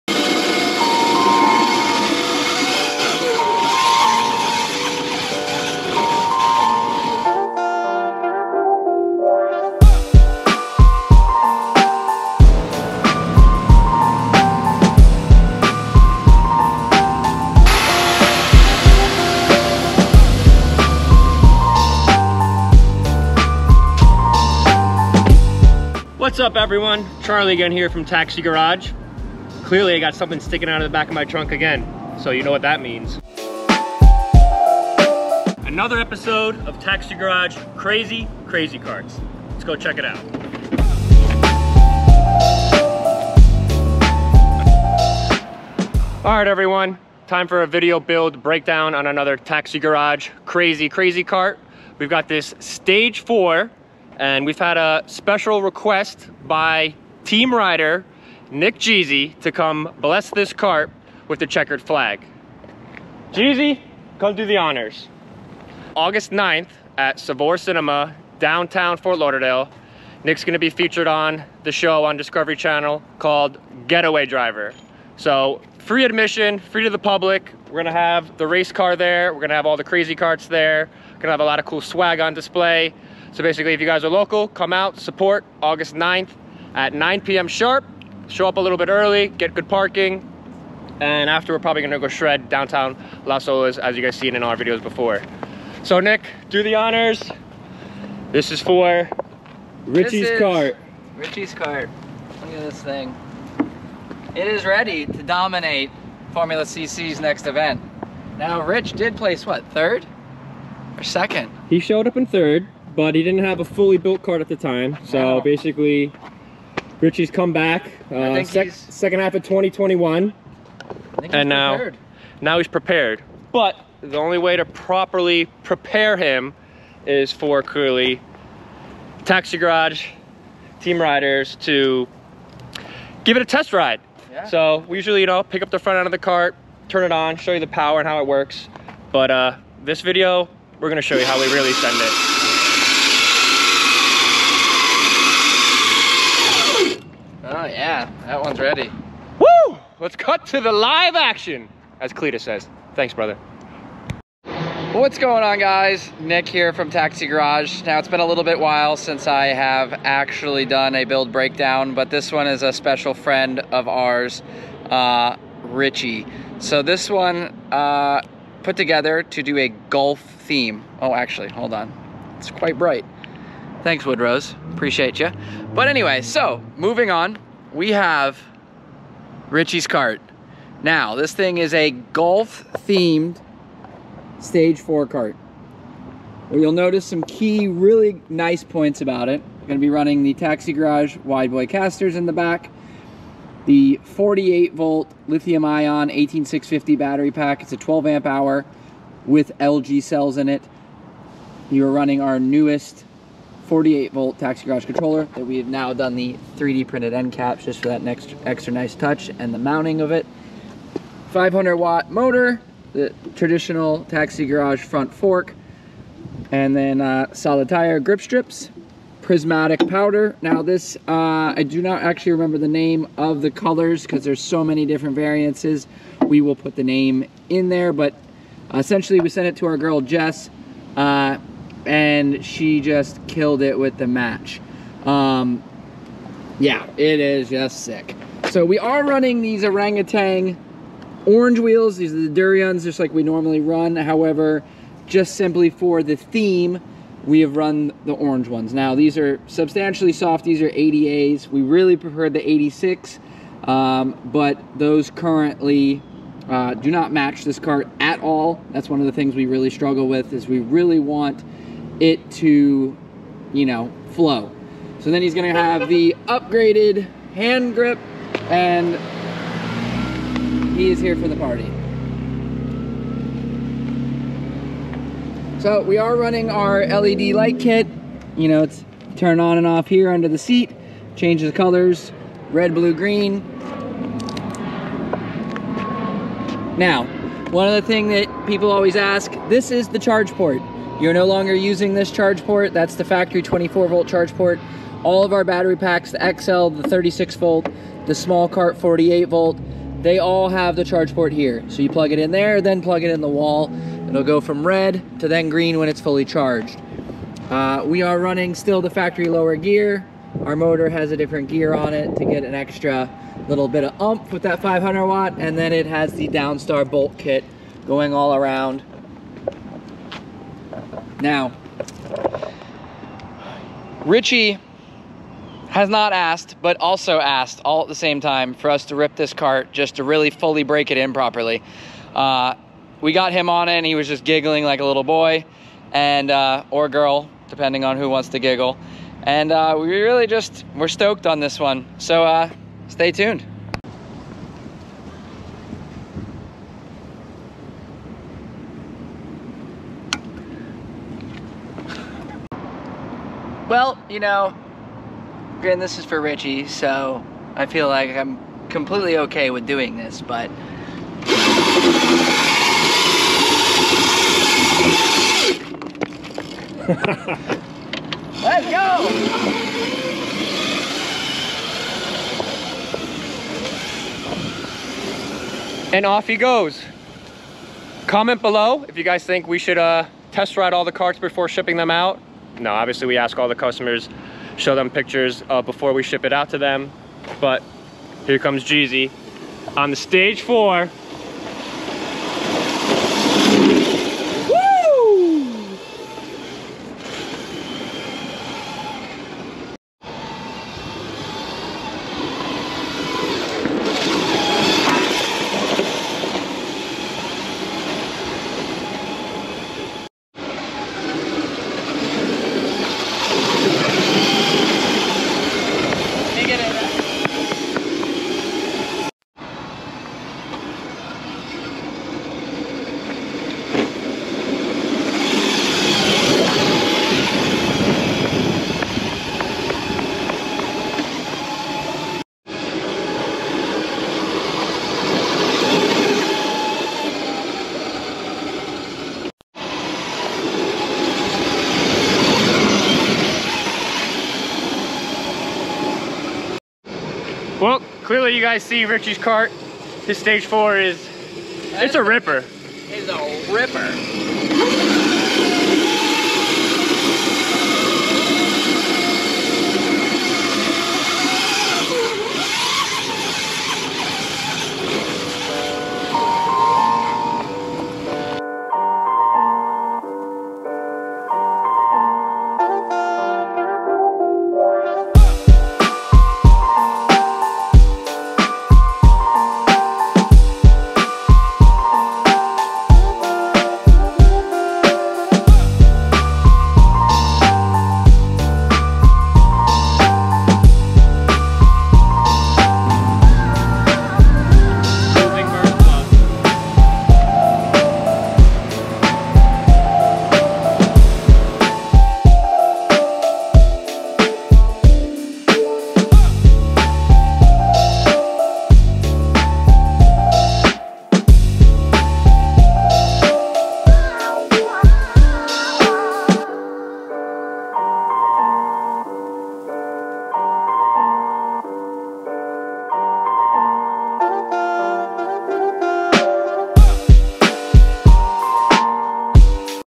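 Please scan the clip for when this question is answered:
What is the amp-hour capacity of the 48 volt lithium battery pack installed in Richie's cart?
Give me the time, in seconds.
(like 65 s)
197 s.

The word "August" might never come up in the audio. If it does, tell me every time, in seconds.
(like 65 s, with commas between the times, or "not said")
65 s, 85 s.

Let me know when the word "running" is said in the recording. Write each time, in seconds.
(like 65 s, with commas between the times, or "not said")
189 s, 201 s, 239 s, 276 s, 308 s.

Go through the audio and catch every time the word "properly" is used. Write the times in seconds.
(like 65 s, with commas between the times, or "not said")
124 s, 331 s.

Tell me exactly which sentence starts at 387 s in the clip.
But here comes Jeezy on the stage four.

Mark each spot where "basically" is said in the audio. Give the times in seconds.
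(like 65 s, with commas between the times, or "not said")
83 s, 115 s.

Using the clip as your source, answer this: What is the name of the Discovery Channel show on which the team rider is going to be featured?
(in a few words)
Getaway Driver.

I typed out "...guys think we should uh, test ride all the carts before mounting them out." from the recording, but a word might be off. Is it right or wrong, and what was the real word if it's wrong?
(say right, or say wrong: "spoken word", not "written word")
wrong: "shipping", not "mounting".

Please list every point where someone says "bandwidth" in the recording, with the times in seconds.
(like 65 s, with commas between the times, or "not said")
not said.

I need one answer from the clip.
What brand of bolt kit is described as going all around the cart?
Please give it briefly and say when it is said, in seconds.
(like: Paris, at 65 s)
Downstar, at 316 s.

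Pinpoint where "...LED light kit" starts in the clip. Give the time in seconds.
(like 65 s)
276 s.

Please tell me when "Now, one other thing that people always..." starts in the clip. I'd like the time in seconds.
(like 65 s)
286 s.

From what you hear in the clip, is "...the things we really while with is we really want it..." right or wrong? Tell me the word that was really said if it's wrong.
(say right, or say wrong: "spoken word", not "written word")
wrong: "struggle", not "while".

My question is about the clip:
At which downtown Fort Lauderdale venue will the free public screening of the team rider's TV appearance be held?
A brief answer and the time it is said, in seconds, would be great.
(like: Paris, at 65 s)
Savor Cinema, at 67 s.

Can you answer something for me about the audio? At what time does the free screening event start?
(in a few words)
9 p.m.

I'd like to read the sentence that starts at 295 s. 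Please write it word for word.
All of our battery packs, the XL, the 36 volt, the small cart 48 volt, they all have the charge port here.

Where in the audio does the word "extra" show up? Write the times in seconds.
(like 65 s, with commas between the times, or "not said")
208 s, 312 s.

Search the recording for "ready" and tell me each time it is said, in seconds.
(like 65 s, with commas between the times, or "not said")
104 s, 148 s.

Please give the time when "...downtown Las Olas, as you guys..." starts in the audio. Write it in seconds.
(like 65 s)
92 s.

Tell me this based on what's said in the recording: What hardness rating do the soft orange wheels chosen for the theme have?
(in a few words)
80A.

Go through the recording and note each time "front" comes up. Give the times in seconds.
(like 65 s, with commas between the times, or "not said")
135 s, 214 s.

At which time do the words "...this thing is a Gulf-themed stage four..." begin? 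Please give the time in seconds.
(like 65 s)
181 s.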